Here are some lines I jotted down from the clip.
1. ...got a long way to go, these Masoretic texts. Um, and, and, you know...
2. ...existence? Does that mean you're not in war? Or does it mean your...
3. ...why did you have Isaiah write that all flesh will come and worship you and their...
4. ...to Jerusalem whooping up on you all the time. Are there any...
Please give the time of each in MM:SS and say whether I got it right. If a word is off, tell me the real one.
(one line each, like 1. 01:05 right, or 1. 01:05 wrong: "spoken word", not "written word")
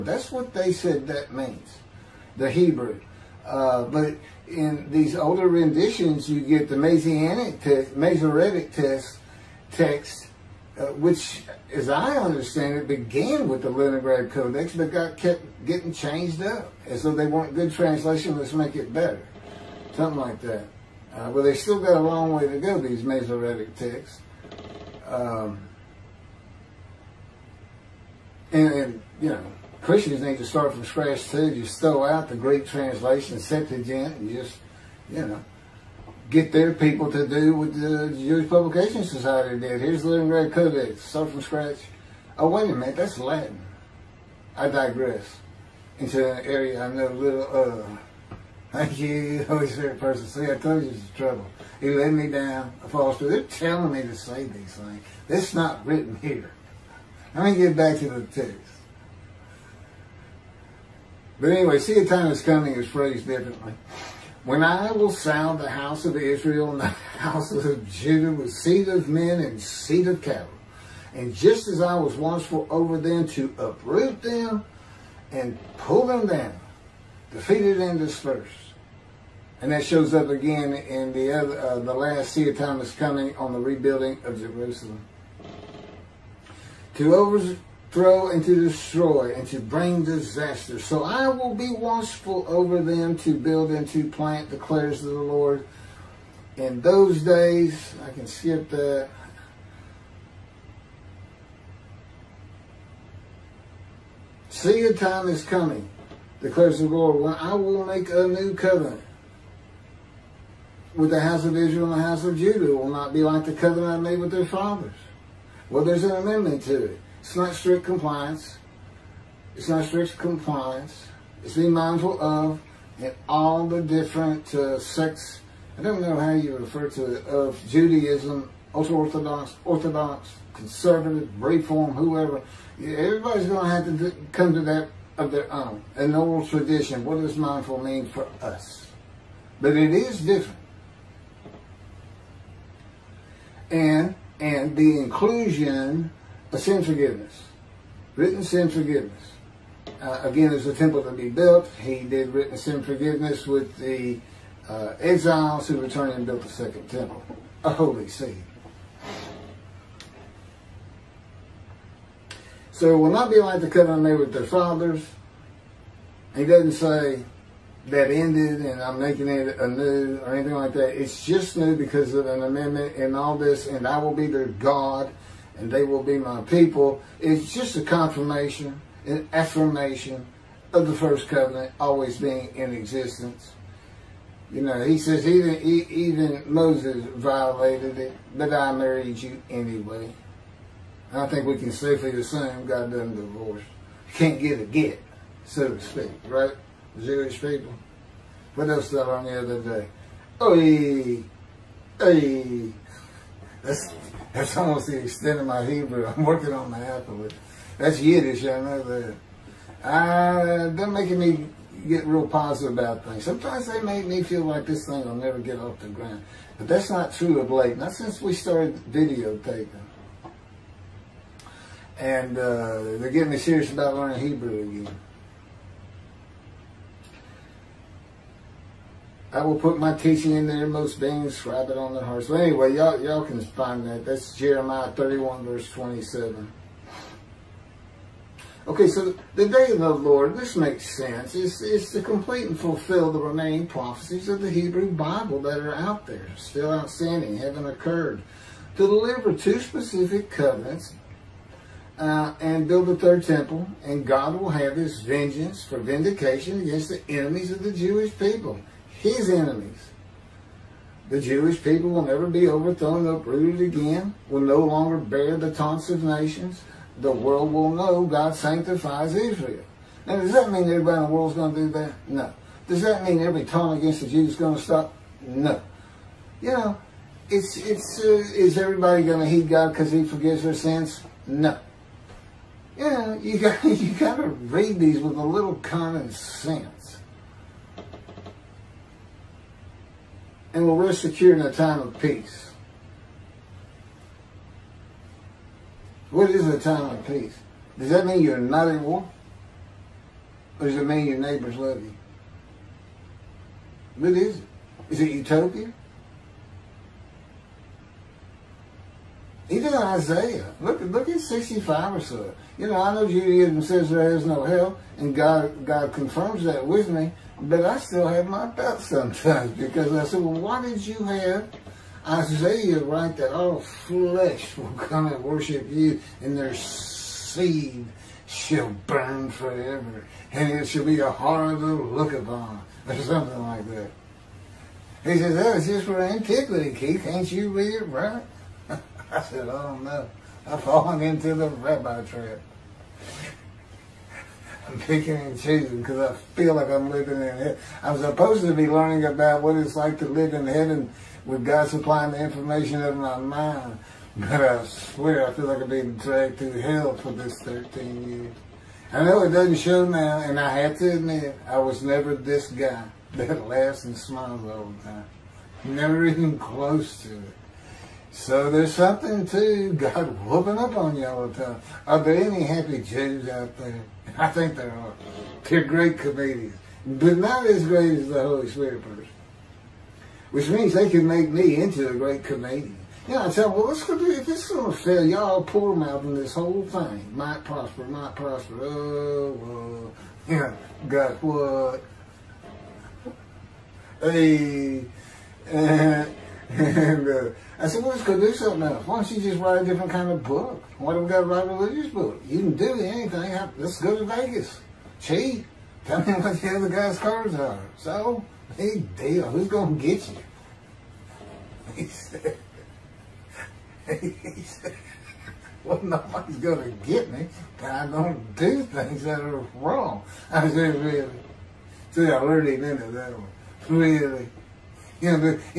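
1. 00:21 right
2. 04:57 wrong: "peace", not "existence"
3. 05:20 right
4. 06:09 wrong: "God", not "Jerusalem".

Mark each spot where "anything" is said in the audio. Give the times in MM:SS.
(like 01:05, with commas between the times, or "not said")
02:50, 06:42.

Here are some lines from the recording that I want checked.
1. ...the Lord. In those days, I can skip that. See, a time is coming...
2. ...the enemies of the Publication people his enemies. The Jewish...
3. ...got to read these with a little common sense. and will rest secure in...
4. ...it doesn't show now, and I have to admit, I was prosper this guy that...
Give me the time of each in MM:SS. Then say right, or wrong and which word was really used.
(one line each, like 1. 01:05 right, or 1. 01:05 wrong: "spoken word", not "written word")
1. 01:35 right
2. 04:16 wrong: "Jewish", not "Publication"
3. 04:43 right
4. 05:59 wrong: "never", not "prosper".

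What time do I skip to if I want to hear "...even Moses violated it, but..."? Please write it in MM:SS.
03:05.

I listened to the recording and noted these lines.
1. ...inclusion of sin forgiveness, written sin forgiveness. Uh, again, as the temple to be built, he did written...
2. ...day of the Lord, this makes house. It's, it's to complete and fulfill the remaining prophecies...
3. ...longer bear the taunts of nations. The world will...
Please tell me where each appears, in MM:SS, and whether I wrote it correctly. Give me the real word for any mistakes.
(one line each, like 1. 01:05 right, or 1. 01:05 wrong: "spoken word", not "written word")
1. 02:24 right
2. 03:59 wrong: "sense", not "house"
3. 04:24 right.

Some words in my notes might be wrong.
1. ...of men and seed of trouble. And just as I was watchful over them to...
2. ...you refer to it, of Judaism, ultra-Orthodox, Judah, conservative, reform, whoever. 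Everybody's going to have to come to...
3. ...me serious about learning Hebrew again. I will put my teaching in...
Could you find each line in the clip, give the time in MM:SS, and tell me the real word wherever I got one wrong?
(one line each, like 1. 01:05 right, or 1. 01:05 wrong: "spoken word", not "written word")
1. 01:08 wrong: "cattle", not "trouble"
2. 02:06 wrong: "Orthodox", not "Judah"
3. 03:43 right.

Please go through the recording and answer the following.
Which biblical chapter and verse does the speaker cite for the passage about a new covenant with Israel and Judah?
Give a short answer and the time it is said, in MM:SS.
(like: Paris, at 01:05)
Jeremiah 31:27, at 03:54.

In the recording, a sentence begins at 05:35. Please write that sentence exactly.
He says, oh, it's just for antiquity, Keith.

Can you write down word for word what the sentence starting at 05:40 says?
I've fallen into the rabbi trap.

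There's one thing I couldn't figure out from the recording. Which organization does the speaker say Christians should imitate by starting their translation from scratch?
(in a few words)
Jewish Publication Society.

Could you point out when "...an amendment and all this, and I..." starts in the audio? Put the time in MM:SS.
02:52.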